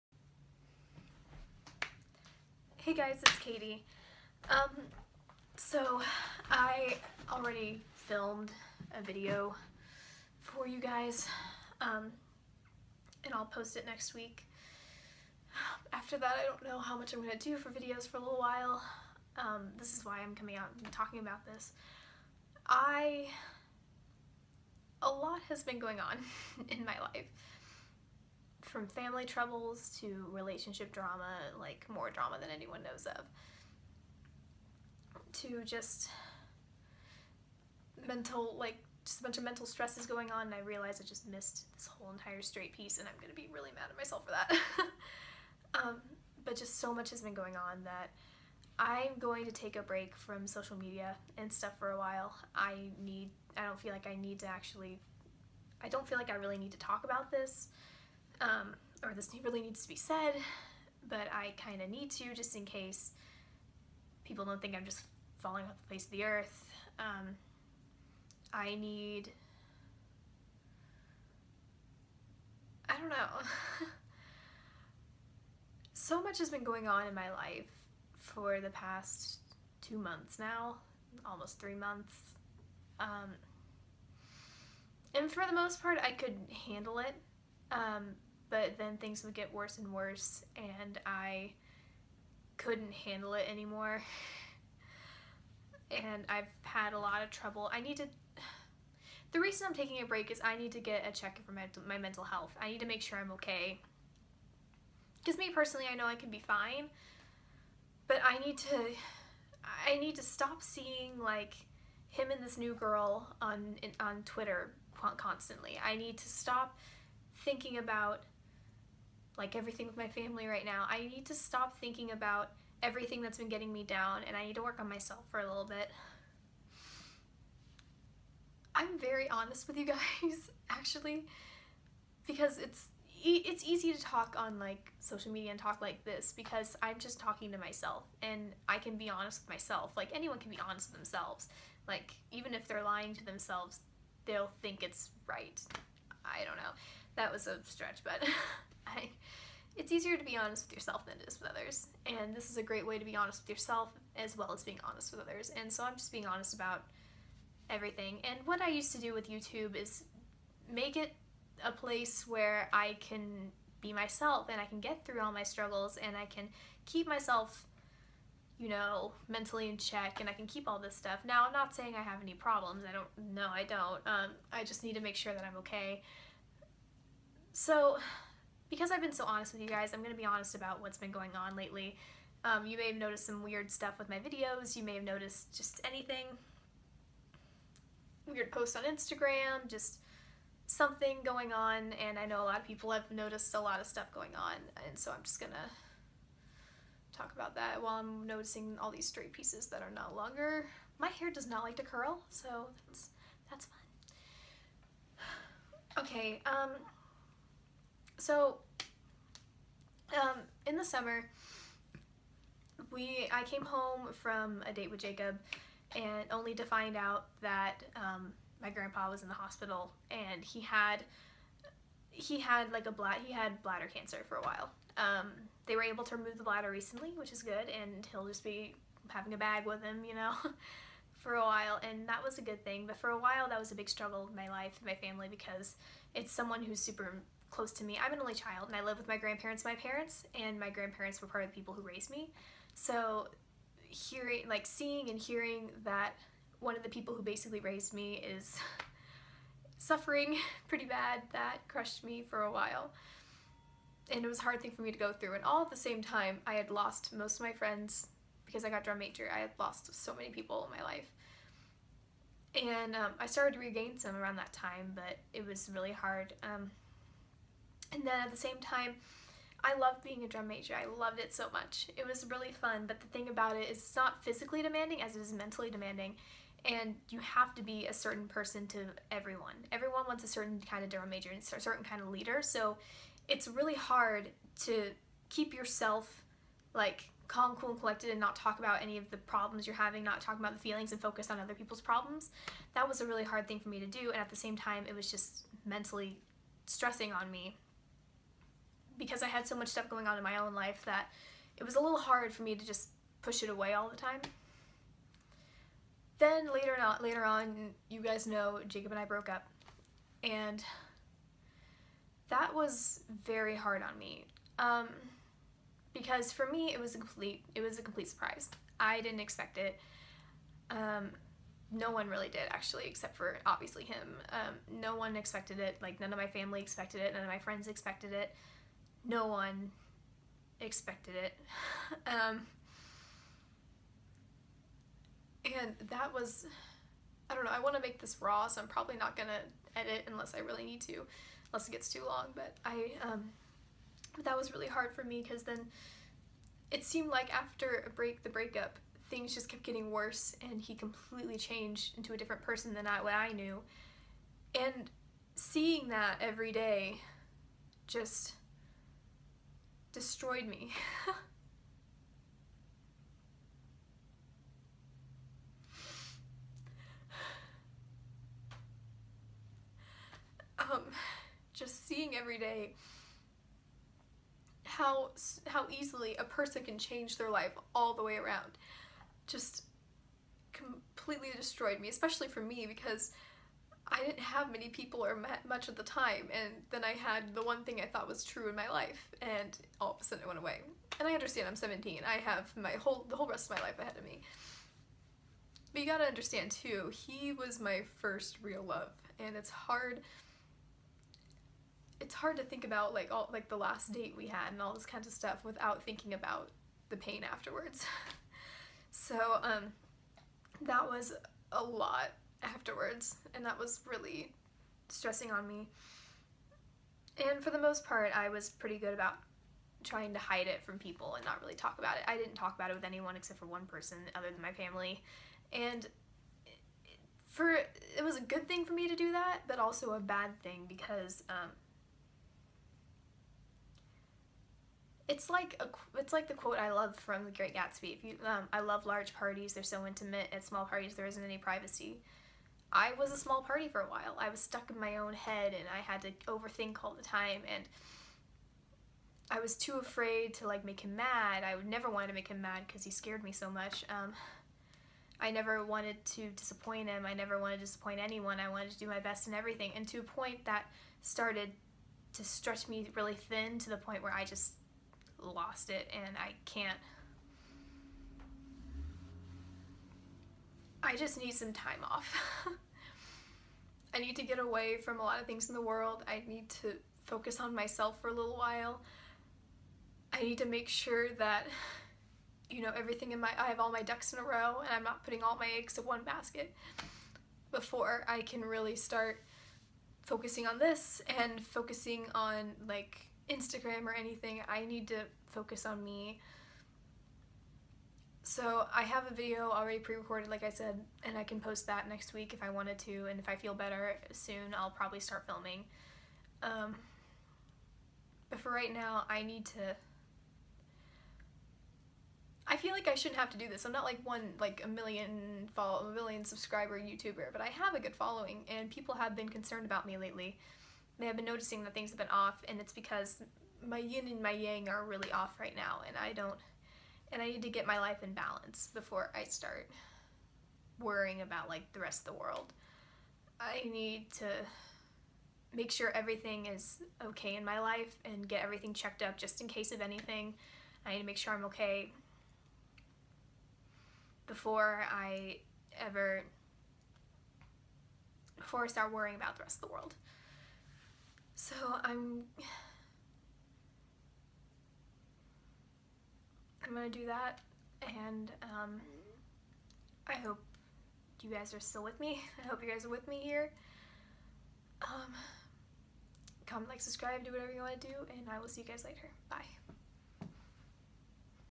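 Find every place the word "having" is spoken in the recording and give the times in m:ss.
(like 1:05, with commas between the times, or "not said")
3:49, 4:49.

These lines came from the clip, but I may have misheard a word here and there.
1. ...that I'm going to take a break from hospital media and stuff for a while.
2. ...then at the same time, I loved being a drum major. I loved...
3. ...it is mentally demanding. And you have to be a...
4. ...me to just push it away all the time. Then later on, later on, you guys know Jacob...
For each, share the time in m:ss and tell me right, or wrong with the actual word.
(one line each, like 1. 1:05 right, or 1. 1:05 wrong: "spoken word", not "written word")
1. 0:47 wrong: "social", not "hospital"
2. 4:28 right
3. 4:35 right
4. 5:02 right.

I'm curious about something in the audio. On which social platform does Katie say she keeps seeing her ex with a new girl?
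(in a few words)
Twitter.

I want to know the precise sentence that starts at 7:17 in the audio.
If you, um, I love large parties; they're so intimate.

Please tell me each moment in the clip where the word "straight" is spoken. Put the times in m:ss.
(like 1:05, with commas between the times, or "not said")
0:42, 3:19.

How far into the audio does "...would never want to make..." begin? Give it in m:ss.
7:31.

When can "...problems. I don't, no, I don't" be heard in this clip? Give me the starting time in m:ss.
2:52.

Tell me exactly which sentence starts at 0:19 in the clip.
Um, this is why I'm coming out and talking about this.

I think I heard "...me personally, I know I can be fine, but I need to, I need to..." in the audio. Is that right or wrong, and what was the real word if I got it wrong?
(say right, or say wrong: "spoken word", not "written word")
right.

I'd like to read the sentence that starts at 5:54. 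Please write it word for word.
And seeing that every day just destroyed me.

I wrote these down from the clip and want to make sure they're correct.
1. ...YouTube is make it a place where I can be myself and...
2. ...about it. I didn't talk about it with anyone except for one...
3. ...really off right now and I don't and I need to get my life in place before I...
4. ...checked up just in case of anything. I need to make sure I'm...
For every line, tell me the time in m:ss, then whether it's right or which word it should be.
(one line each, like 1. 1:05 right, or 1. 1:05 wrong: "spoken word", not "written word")
1. 2:39 right
2. 7:01 right
3. 8:44 wrong: "balance", not "place"
4. 8:58 right.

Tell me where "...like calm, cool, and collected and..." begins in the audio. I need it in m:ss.
4:46.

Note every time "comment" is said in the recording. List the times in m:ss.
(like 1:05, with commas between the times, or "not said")
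9:26.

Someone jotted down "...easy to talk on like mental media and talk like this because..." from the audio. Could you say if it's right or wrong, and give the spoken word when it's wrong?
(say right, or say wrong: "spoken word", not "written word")
wrong: "social", not "mental".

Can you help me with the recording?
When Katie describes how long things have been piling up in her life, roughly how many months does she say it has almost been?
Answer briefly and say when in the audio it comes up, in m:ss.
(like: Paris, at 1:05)
3, at 1:21.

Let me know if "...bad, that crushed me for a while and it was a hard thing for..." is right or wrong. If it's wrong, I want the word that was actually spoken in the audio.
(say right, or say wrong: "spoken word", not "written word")
right.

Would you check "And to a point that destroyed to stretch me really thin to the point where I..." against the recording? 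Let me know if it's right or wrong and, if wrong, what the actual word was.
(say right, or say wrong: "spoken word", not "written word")
wrong: "started", not "destroyed".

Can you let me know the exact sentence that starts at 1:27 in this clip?
Um, but then things would get worse and worse and I couldn't handle it anymore.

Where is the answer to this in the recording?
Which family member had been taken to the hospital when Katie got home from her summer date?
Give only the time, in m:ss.
3:38.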